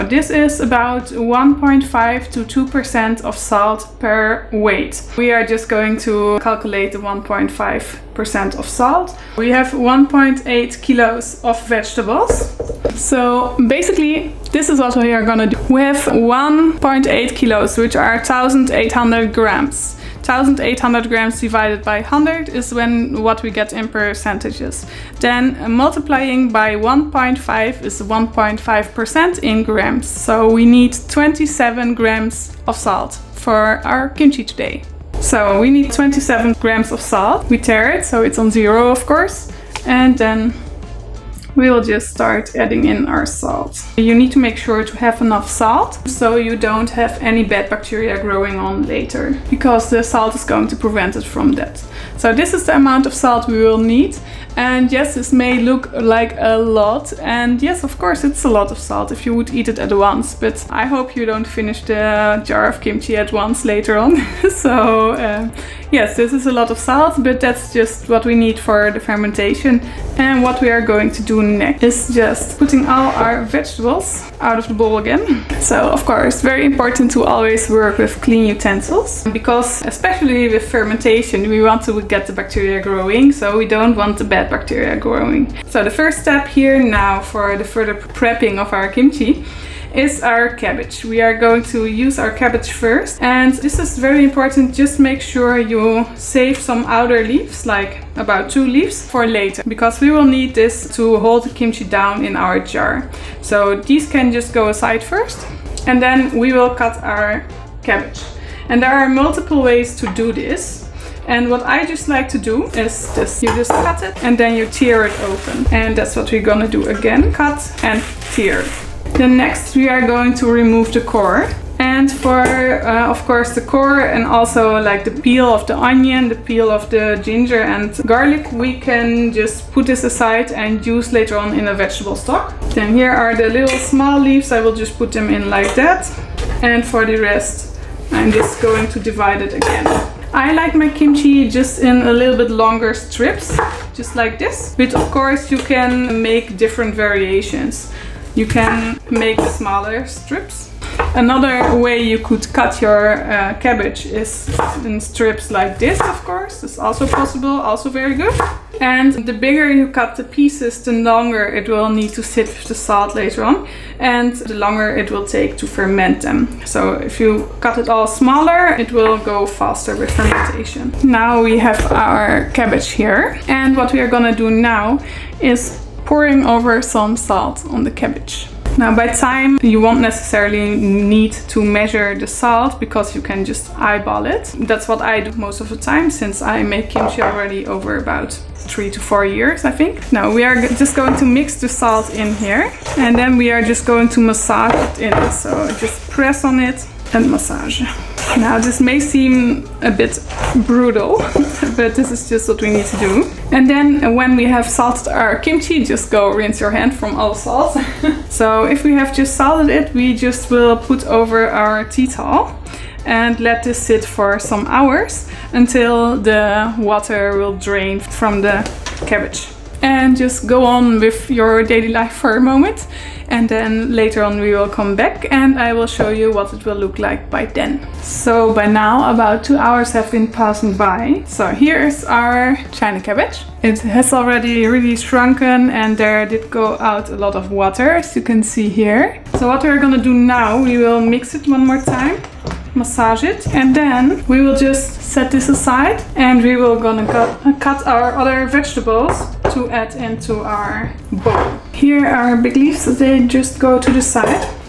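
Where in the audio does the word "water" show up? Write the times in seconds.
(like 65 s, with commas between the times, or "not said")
216 s, 237 s.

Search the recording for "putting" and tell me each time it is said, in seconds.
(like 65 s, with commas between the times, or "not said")
72 s.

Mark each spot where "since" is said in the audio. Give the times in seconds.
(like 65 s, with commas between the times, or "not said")
186 s.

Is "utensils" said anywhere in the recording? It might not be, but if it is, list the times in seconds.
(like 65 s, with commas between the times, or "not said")
78 s.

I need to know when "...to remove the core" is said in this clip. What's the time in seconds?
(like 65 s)
120 s.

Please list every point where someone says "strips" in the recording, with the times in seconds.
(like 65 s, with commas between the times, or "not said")
142 s, 150 s, 155 s.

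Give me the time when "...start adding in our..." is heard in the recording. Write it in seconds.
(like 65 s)
42 s.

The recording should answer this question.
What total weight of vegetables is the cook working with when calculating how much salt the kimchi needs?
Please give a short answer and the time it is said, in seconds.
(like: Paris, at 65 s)
1.8 kilos, at 9 s.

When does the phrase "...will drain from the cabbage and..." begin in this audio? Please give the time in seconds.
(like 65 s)
217 s.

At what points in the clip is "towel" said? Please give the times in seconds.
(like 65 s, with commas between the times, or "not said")
212 s.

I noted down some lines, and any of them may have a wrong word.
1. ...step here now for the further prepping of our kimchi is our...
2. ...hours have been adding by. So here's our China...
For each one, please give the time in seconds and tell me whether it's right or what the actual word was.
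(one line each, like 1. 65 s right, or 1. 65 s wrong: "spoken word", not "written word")
1. 86 s right
2. 229 s wrong: "passing", not "adding".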